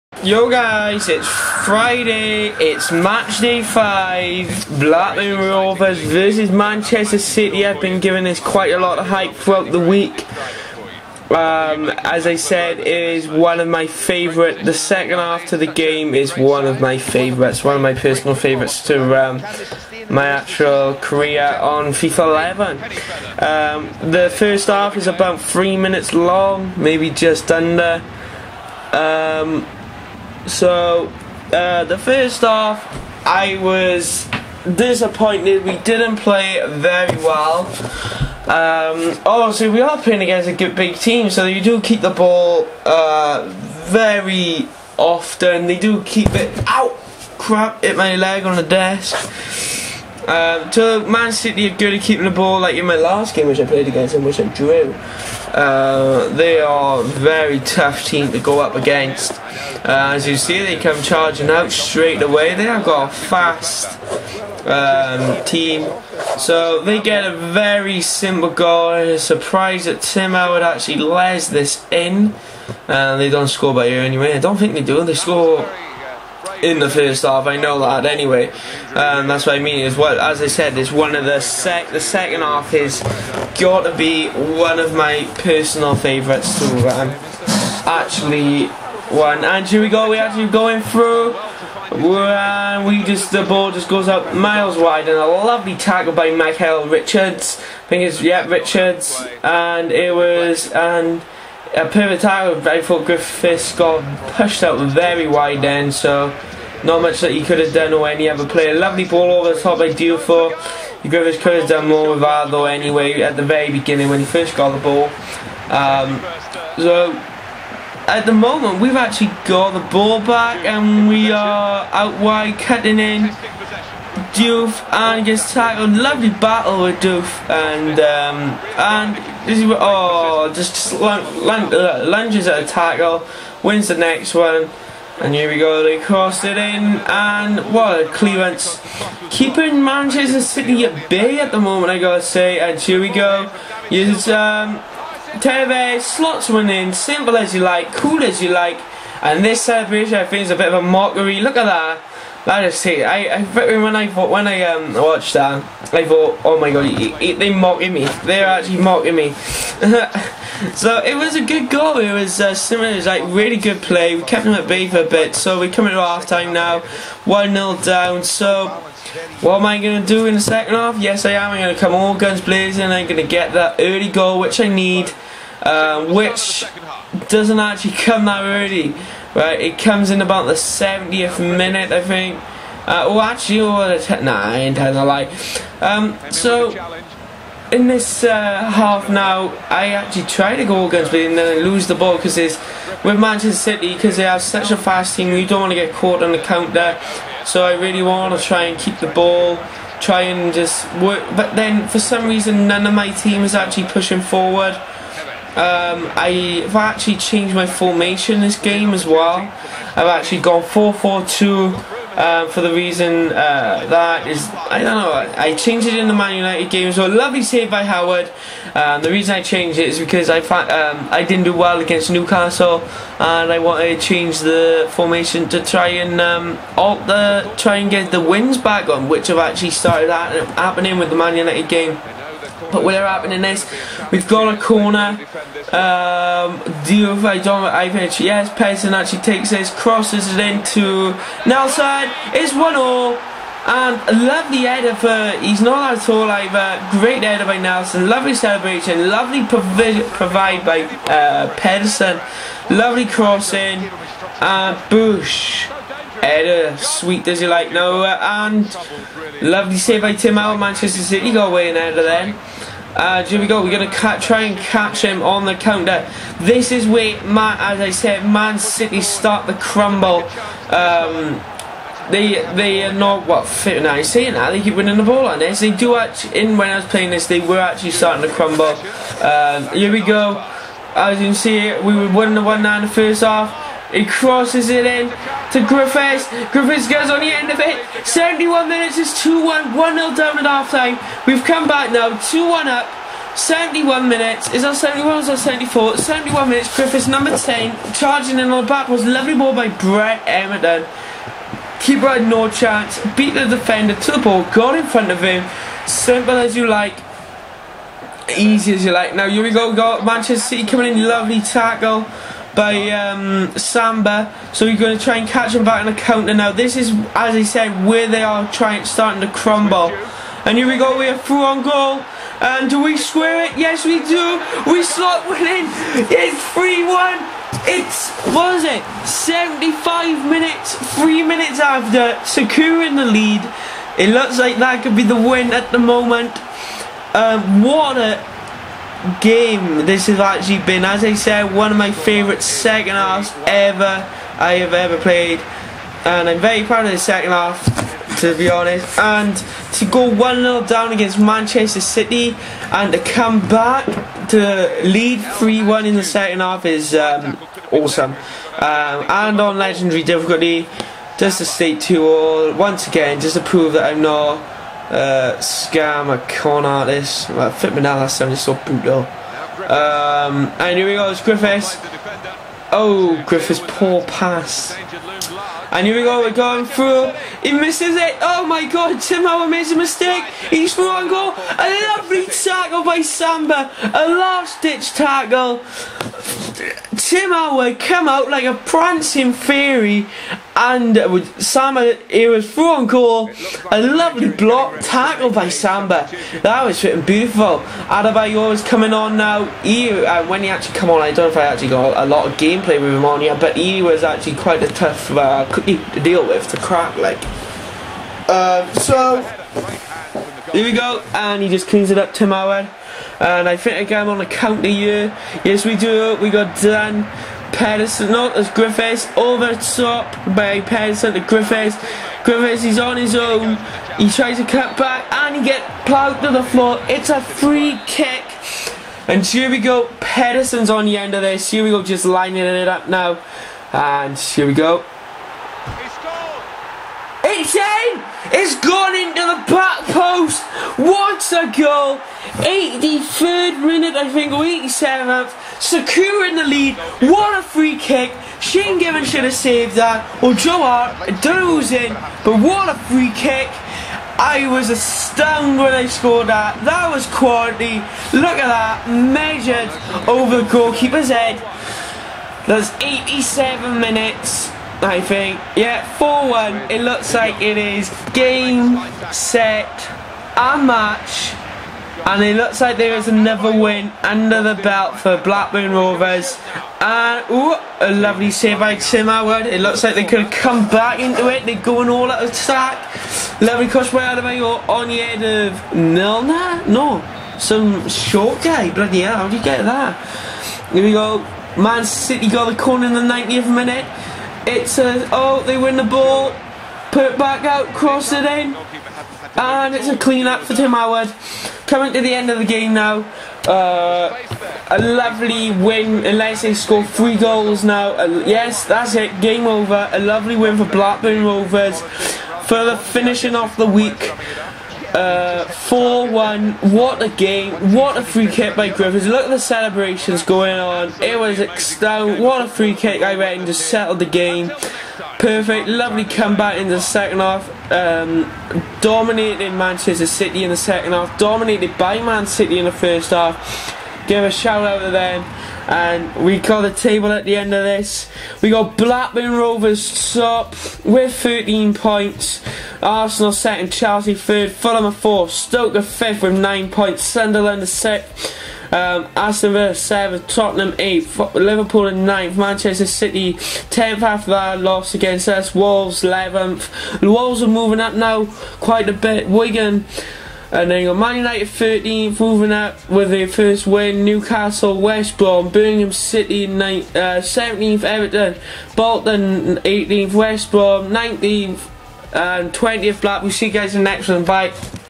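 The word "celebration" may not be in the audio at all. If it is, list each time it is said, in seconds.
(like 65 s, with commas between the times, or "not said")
149 s, 248 s, 519 s.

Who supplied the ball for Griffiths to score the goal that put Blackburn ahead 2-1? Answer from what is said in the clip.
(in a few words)
Brett Emerton.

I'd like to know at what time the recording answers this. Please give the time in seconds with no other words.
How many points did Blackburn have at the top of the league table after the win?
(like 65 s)
541 s.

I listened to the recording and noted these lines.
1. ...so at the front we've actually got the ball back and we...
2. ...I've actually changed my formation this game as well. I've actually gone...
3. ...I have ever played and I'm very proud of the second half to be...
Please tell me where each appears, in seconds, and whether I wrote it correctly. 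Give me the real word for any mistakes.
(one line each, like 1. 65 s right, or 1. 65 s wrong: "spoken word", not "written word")
1. 116 s wrong: "moment", not "front"
2. 206 s right
3. 344 s right.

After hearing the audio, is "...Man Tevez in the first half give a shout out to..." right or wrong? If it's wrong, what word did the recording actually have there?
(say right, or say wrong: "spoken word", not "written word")
wrong: "City", not "Tevez".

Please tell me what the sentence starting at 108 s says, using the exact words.
Lovely ball over the top by Diouf.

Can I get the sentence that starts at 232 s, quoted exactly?
But whatever happened in this, we've got a corner.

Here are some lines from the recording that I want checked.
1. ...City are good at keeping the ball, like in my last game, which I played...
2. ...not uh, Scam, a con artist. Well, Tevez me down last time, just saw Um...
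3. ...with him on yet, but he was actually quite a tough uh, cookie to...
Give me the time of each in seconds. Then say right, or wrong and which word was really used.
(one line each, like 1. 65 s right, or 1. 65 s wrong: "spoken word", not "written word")
1. 51 s right
2. 364 s wrong: "Flip", not "Tevez"
3. 402 s right.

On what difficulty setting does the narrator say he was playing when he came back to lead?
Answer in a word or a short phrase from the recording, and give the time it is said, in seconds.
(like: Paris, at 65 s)
legendary, at 359 s.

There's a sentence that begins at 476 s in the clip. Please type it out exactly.
And, ooh, a lovely save by Tim Howard.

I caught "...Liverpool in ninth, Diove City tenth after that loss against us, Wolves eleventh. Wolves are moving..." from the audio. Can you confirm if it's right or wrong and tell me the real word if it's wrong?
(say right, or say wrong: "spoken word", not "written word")
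wrong: "Manchester", not "Diove".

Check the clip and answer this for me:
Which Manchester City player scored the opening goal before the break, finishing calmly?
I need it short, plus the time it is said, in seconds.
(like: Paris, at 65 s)
Tevez, at 145 s.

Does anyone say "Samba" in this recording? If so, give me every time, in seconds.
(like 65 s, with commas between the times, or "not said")
313 s, 383 s, 391 s, 395 s.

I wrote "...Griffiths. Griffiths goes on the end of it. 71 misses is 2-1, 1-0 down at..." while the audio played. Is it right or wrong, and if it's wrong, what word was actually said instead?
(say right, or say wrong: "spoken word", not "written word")
wrong: "minutes", not "misses".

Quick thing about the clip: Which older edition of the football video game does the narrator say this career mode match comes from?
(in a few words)
FIFA 11.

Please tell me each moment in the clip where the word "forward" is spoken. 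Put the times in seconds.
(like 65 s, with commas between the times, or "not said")
204 s.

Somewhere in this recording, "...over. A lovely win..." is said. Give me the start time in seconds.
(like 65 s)
509 s.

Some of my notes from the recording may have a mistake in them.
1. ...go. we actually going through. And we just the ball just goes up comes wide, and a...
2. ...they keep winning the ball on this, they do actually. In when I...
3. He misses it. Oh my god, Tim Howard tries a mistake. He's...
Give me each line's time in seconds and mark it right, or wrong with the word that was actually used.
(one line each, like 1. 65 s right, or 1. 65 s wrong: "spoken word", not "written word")
1. 89 s wrong: "miles", not "comes"
2. 274 s right
3. 377 s wrong: "makes", not "tries".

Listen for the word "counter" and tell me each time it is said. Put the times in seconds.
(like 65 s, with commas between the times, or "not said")
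196 s, 265 s, 315 s, 414 s.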